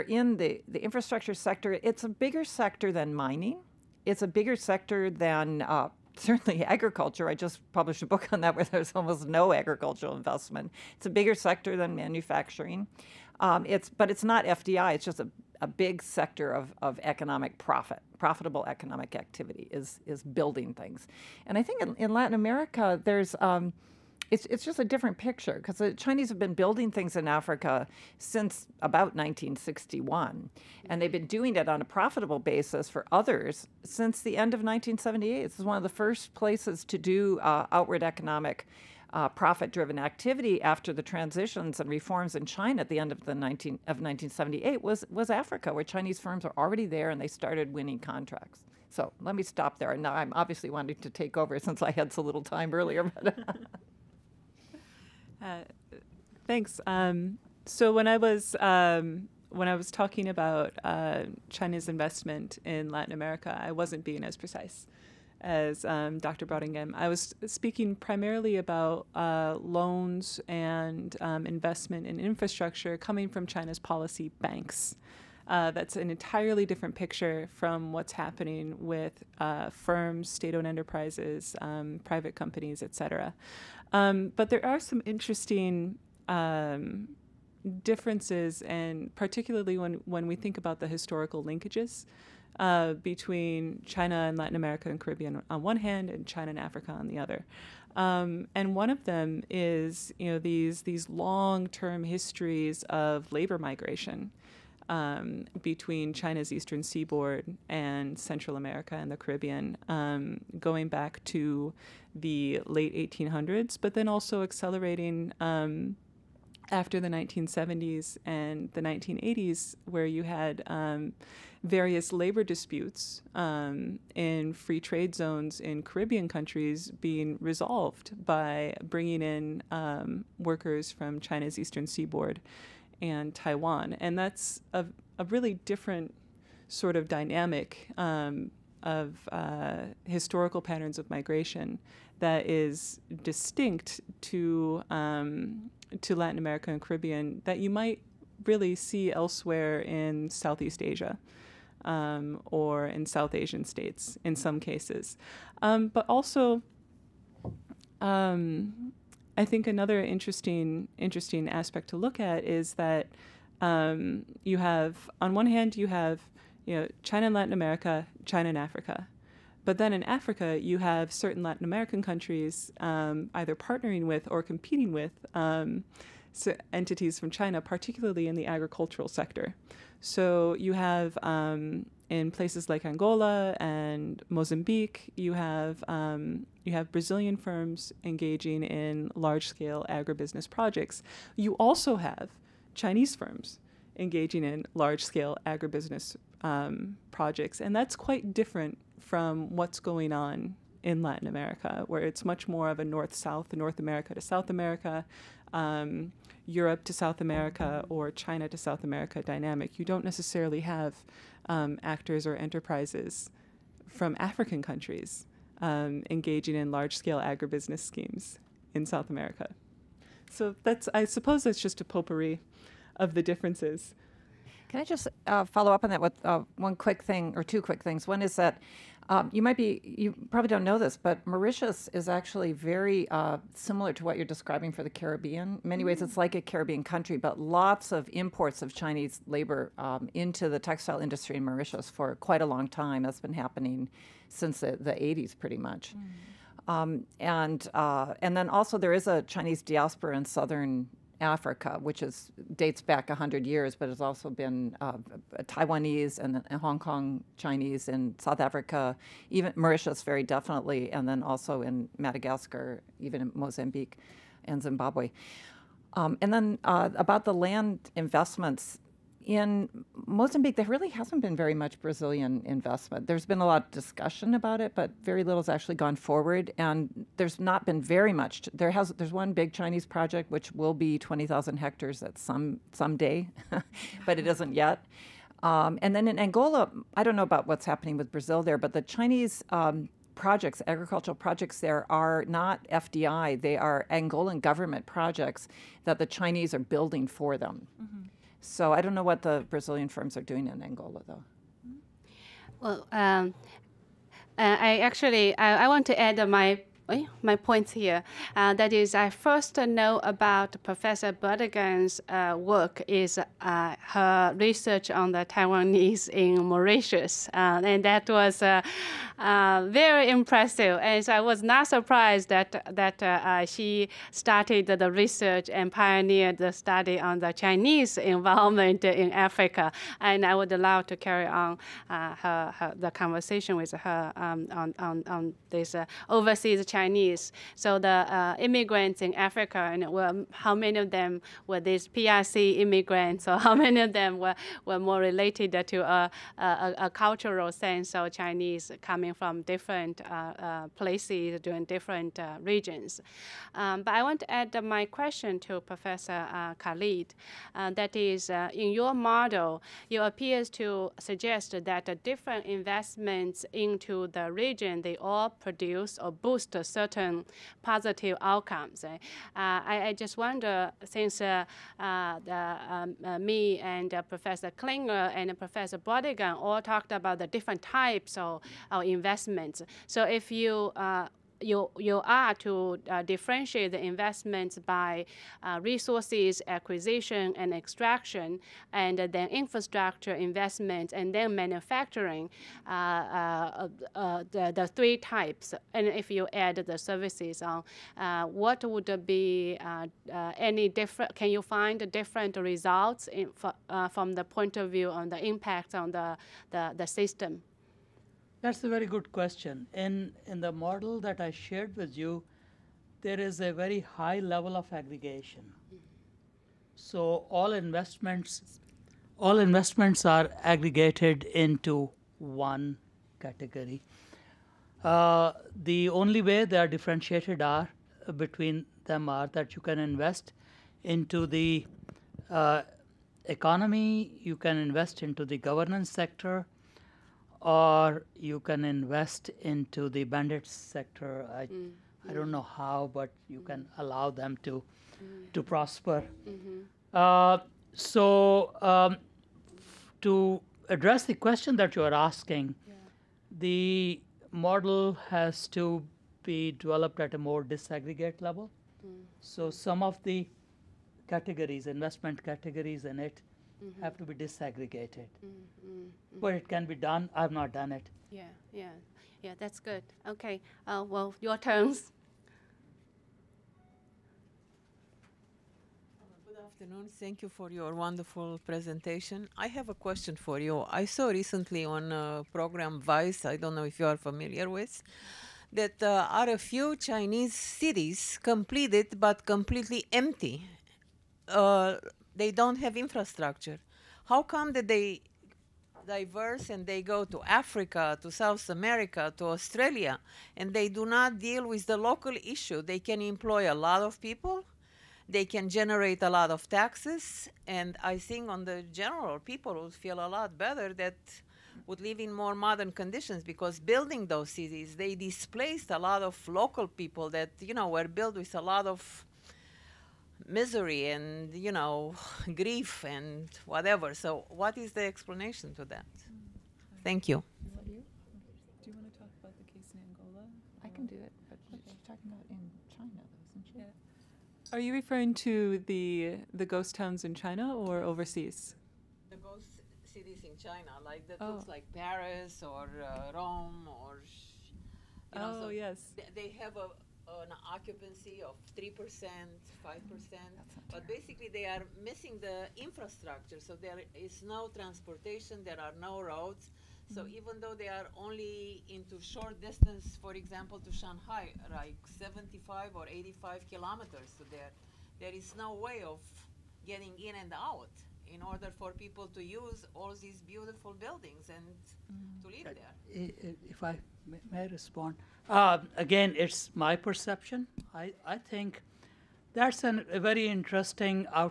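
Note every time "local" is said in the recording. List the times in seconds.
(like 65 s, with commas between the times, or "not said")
501 s, 516 s.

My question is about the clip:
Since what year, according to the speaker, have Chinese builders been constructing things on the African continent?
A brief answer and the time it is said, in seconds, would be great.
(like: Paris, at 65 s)
1961, at 29 s.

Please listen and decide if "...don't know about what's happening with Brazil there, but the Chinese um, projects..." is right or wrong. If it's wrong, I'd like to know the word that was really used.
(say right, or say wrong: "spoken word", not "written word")
right.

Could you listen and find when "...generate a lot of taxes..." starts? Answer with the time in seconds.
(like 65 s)
505 s.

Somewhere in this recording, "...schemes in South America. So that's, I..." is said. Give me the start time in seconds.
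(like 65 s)
217 s.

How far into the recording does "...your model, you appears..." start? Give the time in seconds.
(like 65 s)
358 s.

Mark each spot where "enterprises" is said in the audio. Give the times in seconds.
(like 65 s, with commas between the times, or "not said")
80 s, 212 s.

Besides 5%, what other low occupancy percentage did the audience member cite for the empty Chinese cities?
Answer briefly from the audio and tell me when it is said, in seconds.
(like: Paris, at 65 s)
3%, at 548 s.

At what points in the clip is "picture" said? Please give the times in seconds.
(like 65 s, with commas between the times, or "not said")
25 s, 76 s.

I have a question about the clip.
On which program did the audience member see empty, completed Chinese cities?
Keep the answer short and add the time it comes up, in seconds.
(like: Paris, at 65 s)
Vice, at 482 s.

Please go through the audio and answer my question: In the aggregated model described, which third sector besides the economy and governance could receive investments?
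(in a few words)
bandit sector.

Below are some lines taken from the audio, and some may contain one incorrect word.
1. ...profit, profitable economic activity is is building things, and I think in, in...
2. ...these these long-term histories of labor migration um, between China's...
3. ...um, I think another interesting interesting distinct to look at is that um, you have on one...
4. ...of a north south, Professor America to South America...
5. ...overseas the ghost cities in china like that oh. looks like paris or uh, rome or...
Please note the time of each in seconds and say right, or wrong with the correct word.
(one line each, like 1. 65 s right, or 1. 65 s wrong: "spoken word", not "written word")
1. 17 s right
2. 100 s right
3. 158 s wrong: "aspect", not "distinct"
4. 202 s wrong: "North", not "Professor"
5. 537 s right.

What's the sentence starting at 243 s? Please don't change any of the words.
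That's been happening since the, the 80s, pretty much.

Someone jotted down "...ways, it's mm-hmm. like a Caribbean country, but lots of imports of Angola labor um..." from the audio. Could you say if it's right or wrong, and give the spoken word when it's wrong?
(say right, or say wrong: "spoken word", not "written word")
wrong: "Chinese", not "Angola".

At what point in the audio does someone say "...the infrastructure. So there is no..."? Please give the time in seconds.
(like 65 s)
552 s.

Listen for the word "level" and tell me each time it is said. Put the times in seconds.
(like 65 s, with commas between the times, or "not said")
414 s, 458 s.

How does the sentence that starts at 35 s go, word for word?
This is one of the first places to do uh, outward economic.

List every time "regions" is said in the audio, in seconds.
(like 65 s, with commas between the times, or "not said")
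352 s, 364 s.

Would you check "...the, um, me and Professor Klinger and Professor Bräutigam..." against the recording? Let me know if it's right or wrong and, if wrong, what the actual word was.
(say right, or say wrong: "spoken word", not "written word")
right.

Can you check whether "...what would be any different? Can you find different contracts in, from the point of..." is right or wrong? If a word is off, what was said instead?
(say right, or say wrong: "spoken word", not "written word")
wrong: "results", not "contracts".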